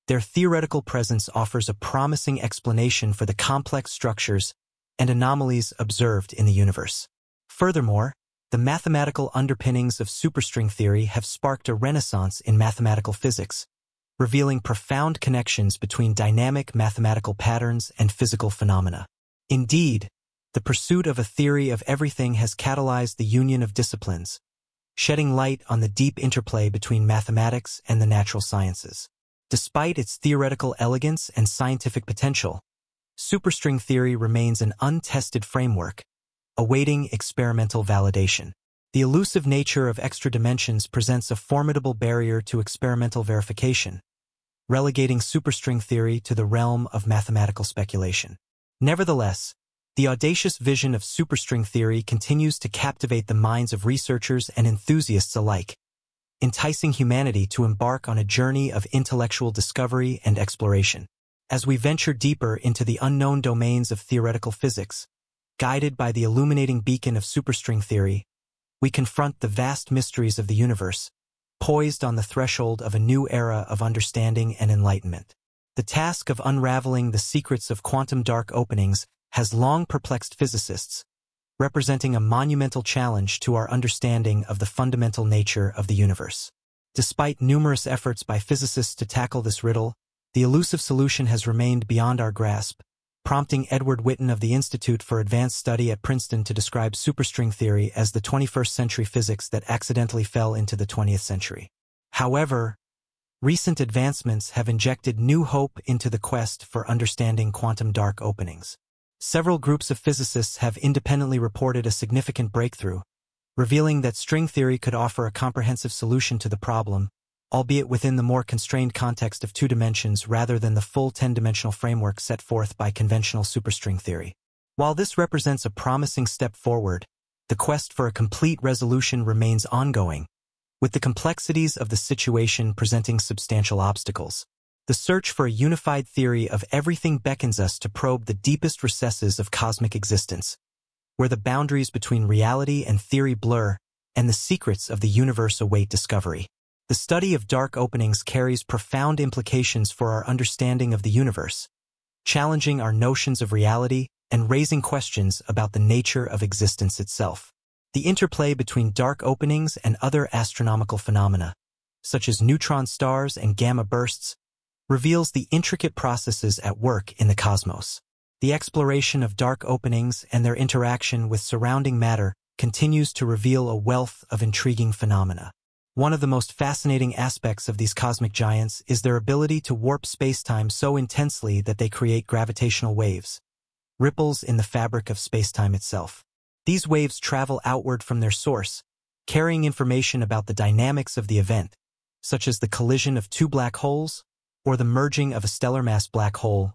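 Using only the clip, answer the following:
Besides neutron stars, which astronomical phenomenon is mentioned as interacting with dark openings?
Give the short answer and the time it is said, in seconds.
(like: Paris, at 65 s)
gamma bursts, at 163 s.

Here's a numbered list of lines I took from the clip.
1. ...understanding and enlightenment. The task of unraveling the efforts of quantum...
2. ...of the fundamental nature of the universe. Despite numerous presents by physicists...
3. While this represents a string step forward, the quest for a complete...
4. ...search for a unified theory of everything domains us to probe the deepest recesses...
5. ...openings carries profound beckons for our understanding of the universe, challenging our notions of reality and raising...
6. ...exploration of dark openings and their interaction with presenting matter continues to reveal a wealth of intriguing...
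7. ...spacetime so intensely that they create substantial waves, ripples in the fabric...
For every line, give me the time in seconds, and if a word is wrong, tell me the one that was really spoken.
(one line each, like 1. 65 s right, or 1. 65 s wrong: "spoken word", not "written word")
1. 73 s wrong: "secrets", not "efforts"
2. 84 s wrong: "efforts", not "presents"
3. 124 s wrong: "promising", not "string"
4. 134 s wrong: "beckons", not "domains"
5. 147 s wrong: "implications", not "beckons"
6. 168 s wrong: "surrounding", not "presenting"
7. 180 s wrong: "gravitational", not "substantial".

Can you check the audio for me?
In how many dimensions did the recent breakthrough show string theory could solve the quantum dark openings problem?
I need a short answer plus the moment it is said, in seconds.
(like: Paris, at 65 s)
2, at 119 s.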